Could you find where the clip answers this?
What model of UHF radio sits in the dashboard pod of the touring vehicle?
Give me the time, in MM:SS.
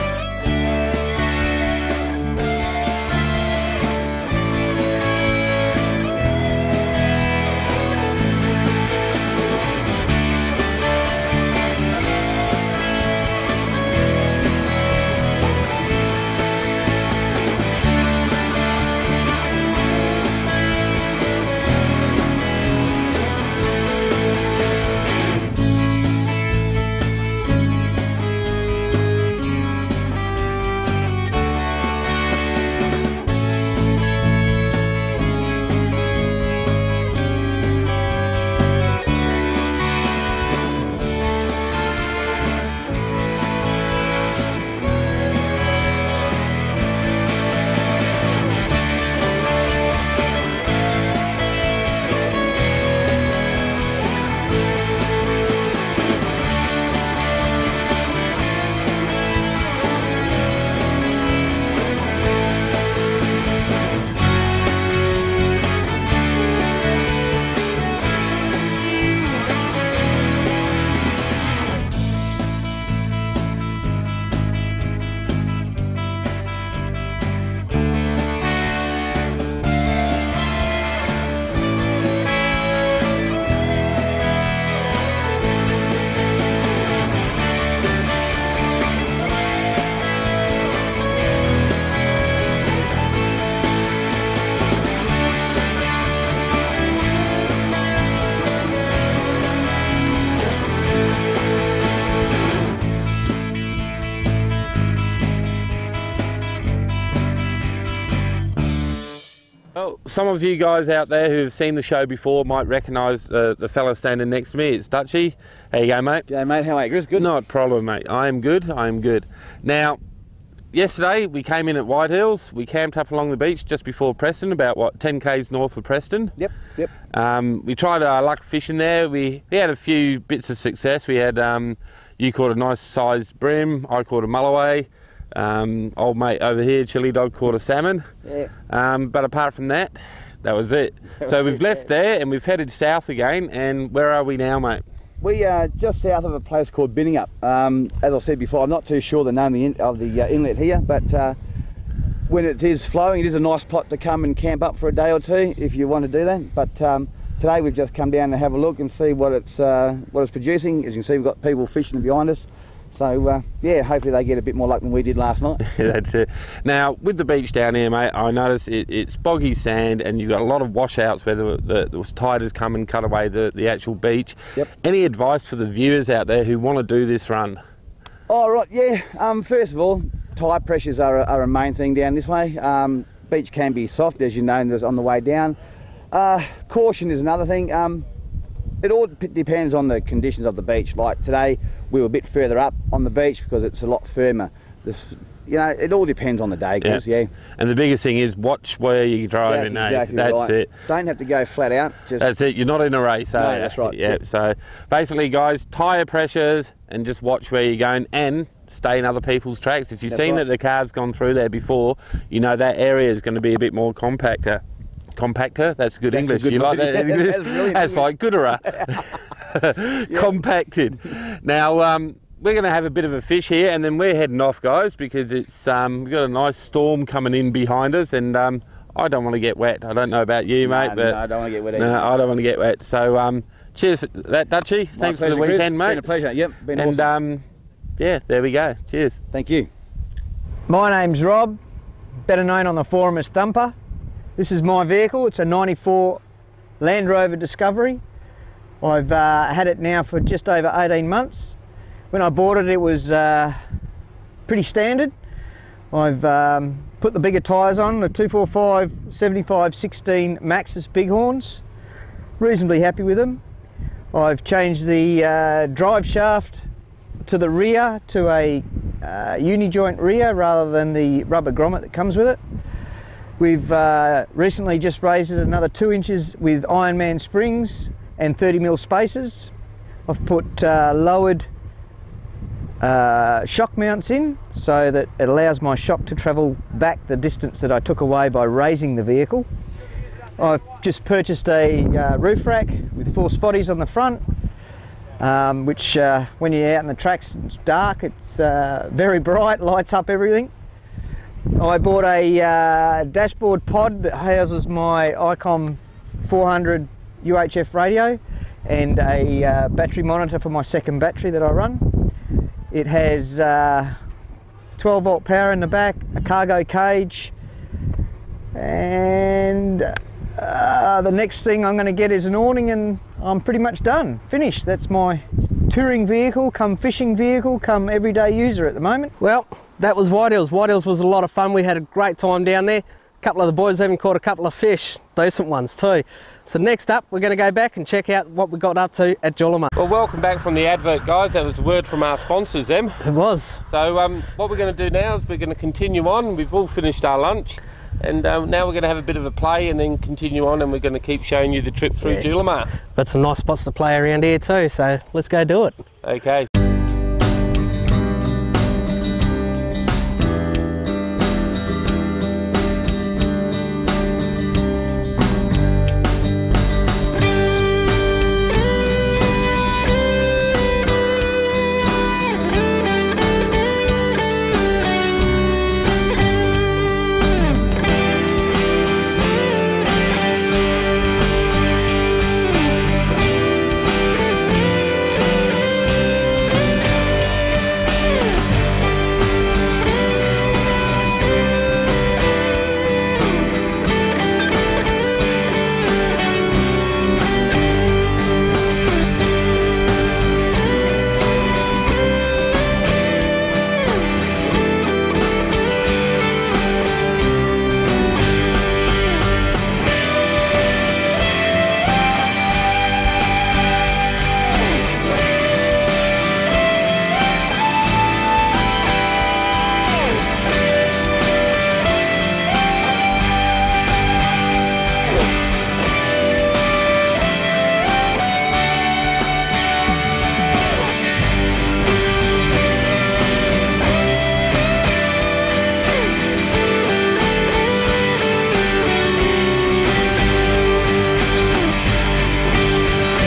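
05:05.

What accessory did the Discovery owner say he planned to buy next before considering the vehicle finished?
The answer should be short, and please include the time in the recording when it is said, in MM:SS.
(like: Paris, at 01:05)
An awning, at 05:22.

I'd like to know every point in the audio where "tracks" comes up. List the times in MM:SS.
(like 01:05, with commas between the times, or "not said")
03:29, 04:56.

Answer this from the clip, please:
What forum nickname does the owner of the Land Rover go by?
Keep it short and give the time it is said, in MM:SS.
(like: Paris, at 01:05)
Thumper, at 04:03.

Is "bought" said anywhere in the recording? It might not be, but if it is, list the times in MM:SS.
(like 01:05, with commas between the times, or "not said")
04:12, 05:01.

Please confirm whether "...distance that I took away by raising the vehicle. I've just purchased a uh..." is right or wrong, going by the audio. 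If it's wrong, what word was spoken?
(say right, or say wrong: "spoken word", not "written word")
right.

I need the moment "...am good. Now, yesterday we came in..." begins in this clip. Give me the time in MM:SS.
01:58.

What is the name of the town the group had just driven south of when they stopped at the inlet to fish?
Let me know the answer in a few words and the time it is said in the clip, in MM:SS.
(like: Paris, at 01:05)
Binningup, at 02:26.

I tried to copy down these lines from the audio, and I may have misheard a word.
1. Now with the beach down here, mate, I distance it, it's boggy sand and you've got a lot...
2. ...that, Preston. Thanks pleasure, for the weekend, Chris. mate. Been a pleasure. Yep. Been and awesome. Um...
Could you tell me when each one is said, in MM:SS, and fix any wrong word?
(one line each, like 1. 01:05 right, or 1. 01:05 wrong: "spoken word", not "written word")
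1. 02:46 wrong: "notice", not "distance"
2. 03:54 wrong: "Dutchie", not "Preston".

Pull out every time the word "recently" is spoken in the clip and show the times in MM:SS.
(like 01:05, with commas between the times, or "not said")
04:34.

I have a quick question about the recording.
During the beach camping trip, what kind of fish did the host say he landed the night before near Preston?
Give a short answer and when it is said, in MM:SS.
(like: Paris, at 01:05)
Mulloway, at 02:14.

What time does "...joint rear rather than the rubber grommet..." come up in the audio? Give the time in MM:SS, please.
04:29.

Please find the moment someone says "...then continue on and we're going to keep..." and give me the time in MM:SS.
05:49.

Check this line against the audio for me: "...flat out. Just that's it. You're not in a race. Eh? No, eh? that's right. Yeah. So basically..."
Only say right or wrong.
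right.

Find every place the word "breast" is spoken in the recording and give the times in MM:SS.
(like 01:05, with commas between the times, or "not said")
not said.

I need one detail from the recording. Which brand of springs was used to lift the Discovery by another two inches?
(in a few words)
Ironman.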